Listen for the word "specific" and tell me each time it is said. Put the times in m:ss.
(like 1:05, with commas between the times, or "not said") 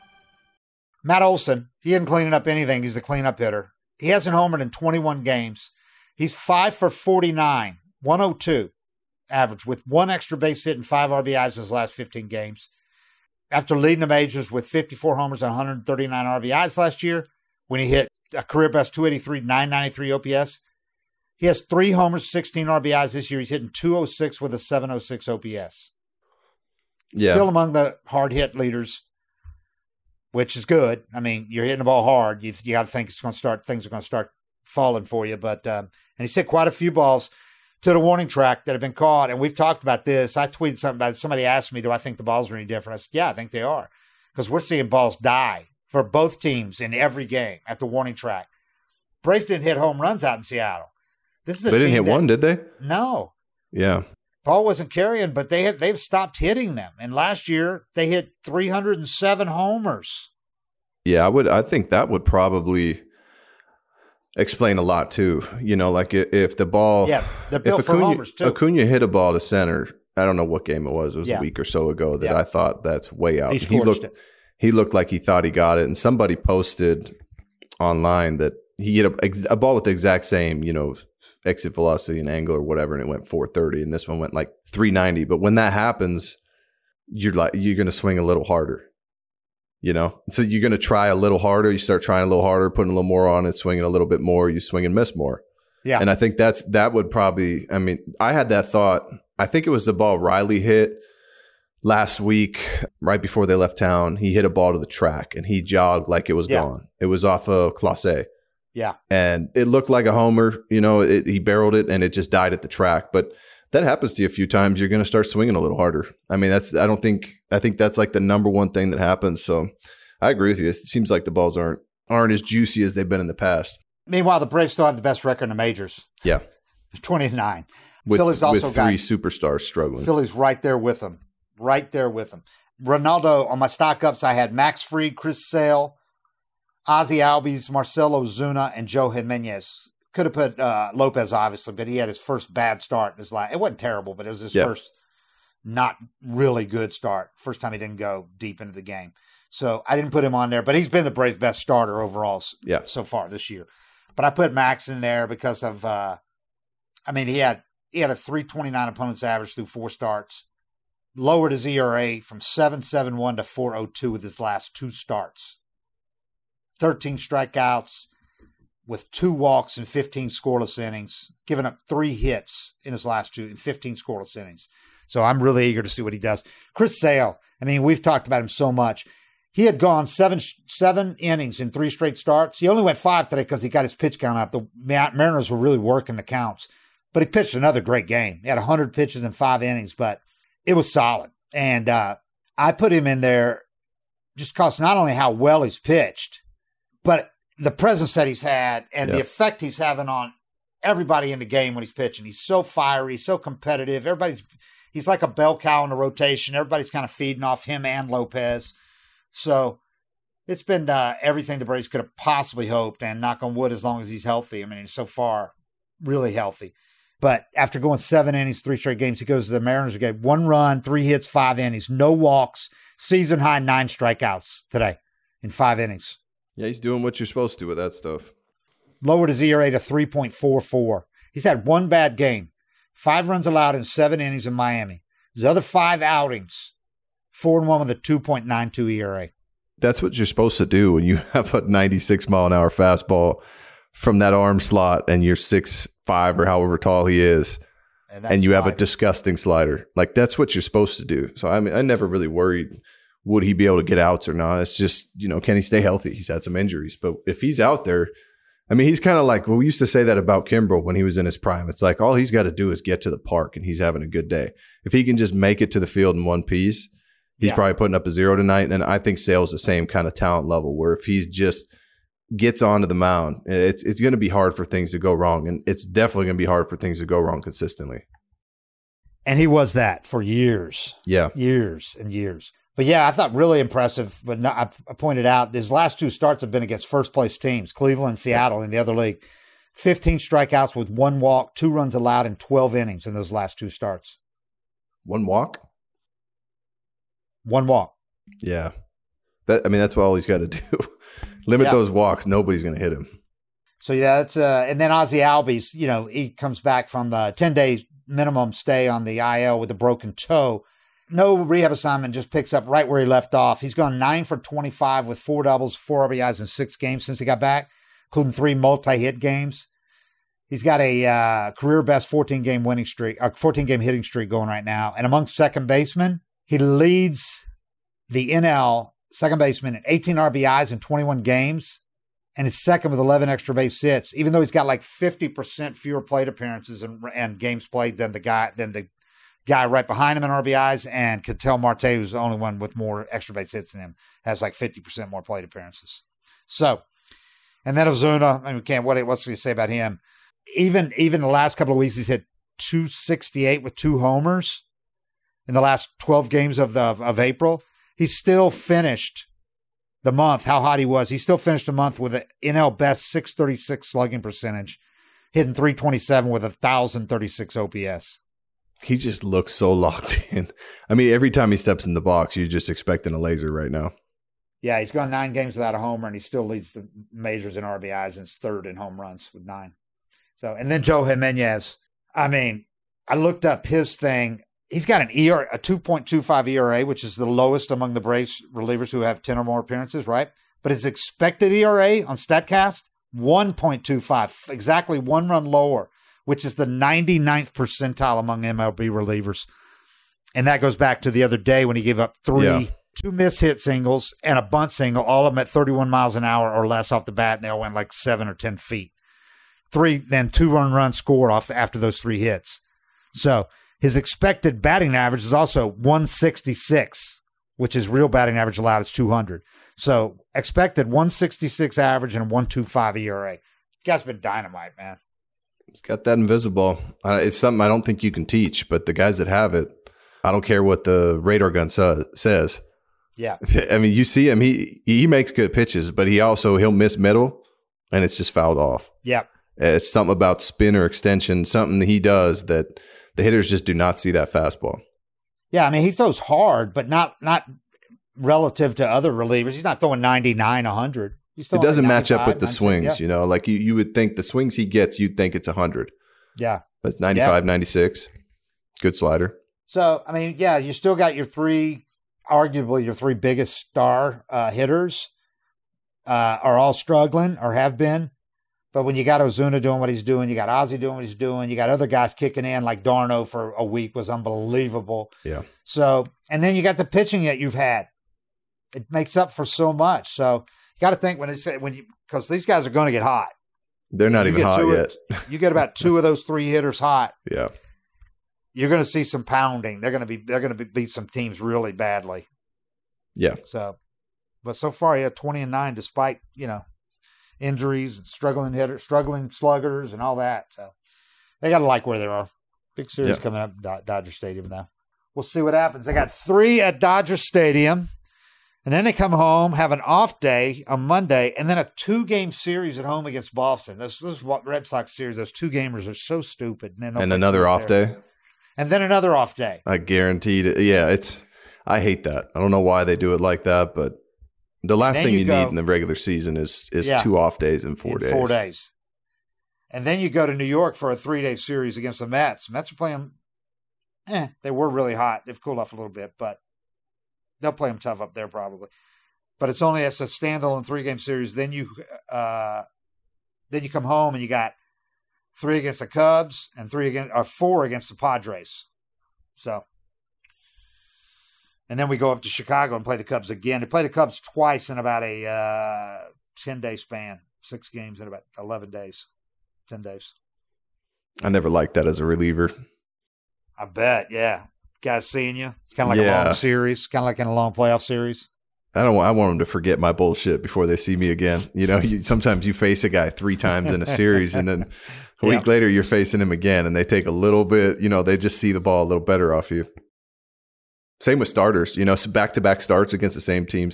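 not said.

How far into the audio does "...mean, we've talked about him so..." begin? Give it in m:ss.
2:57.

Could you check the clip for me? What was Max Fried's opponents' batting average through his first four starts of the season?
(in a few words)
.329.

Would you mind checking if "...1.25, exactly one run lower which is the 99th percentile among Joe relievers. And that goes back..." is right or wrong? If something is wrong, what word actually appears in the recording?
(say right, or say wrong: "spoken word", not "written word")
wrong: "MLB", not "Joe".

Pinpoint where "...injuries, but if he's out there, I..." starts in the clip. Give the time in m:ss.
4:16.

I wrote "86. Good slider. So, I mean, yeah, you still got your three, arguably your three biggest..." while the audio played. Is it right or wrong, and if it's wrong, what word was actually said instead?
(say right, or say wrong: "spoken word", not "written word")
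wrong: "96", not "86".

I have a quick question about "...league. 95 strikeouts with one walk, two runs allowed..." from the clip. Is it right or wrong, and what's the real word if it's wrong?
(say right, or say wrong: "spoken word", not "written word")
wrong: "15", not "95".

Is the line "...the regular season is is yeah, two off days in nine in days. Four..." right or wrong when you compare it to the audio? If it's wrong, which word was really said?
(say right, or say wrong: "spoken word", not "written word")
wrong: "four", not "nine".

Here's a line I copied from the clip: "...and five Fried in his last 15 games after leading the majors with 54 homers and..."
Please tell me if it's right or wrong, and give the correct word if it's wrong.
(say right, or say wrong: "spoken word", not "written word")
wrong: "RBIs", not "Fried".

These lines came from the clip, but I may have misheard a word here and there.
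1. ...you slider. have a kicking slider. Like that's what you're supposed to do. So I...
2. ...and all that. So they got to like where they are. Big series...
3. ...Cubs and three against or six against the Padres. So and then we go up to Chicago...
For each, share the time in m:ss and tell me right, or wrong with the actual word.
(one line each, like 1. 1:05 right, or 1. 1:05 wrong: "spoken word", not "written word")
1. 4:08 wrong: "disgusting", not "kicking"
2. 8:19 right
3. 9:05 wrong: "four", not "six".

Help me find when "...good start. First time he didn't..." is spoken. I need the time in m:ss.
2:26.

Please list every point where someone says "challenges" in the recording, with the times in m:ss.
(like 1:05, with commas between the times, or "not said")
not said.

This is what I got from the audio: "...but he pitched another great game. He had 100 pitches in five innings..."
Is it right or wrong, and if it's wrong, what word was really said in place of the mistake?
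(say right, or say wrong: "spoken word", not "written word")
right.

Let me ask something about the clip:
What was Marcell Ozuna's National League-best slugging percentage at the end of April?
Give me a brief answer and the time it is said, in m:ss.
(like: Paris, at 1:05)
.636, at 6:03.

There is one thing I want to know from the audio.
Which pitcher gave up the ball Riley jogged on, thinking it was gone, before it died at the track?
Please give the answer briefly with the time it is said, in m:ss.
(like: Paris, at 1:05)
Clase, at 1:47.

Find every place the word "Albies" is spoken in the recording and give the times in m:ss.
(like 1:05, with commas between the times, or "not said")
2:17, 5:05.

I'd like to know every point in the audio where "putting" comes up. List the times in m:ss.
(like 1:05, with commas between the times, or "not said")
1:32, 4:27.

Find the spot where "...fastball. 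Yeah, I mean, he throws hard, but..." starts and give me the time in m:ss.
7:24.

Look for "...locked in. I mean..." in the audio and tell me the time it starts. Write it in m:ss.
6:09.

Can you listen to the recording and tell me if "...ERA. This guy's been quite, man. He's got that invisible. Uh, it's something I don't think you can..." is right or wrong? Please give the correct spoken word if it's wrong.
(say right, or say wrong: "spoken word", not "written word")
wrong: "dynamite", not "quite".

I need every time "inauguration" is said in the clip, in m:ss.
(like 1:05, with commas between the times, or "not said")
not said.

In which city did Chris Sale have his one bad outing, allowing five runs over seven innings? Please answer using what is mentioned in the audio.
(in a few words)
Miami.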